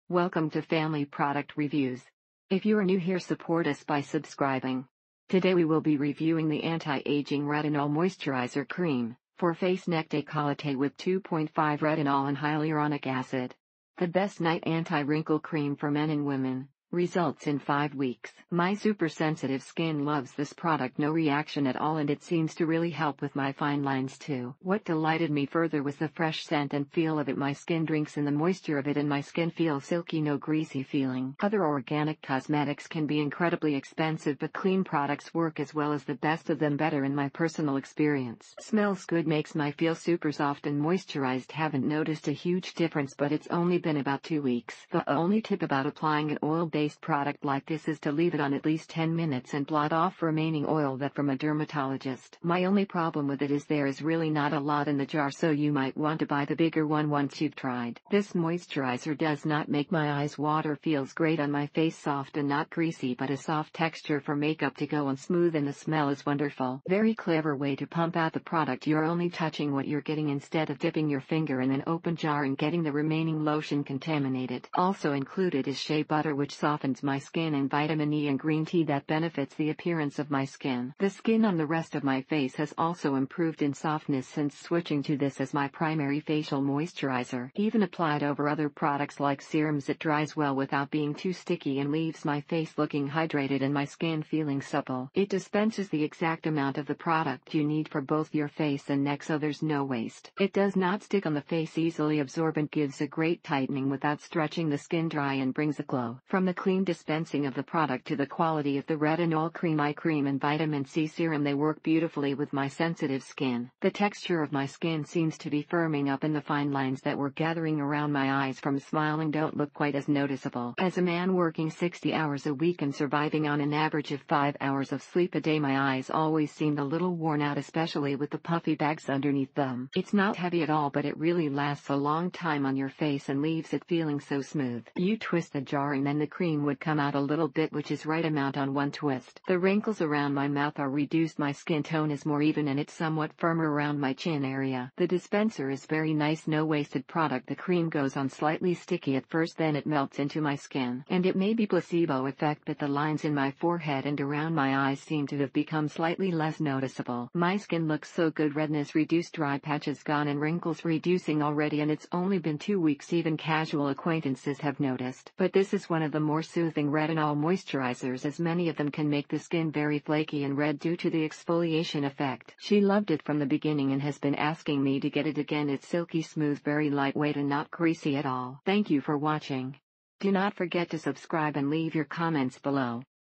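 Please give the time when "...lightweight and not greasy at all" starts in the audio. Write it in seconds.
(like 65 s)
176 s.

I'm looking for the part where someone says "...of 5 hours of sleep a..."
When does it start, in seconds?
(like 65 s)
124 s.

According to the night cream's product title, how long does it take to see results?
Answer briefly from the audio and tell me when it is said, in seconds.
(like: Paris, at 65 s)
5 weeks, at 17 s.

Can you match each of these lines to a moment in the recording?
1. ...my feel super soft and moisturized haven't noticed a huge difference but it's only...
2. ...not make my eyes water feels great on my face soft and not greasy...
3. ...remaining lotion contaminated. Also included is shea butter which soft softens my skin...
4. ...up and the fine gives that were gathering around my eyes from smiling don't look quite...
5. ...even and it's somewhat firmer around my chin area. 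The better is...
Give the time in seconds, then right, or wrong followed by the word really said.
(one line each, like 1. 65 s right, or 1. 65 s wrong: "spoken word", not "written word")
1. 39 s right
2. 59 s right
3. 72 s right
4. 116 s wrong: "lines", not "gives"
5. 142 s wrong: "dispenser", not "better".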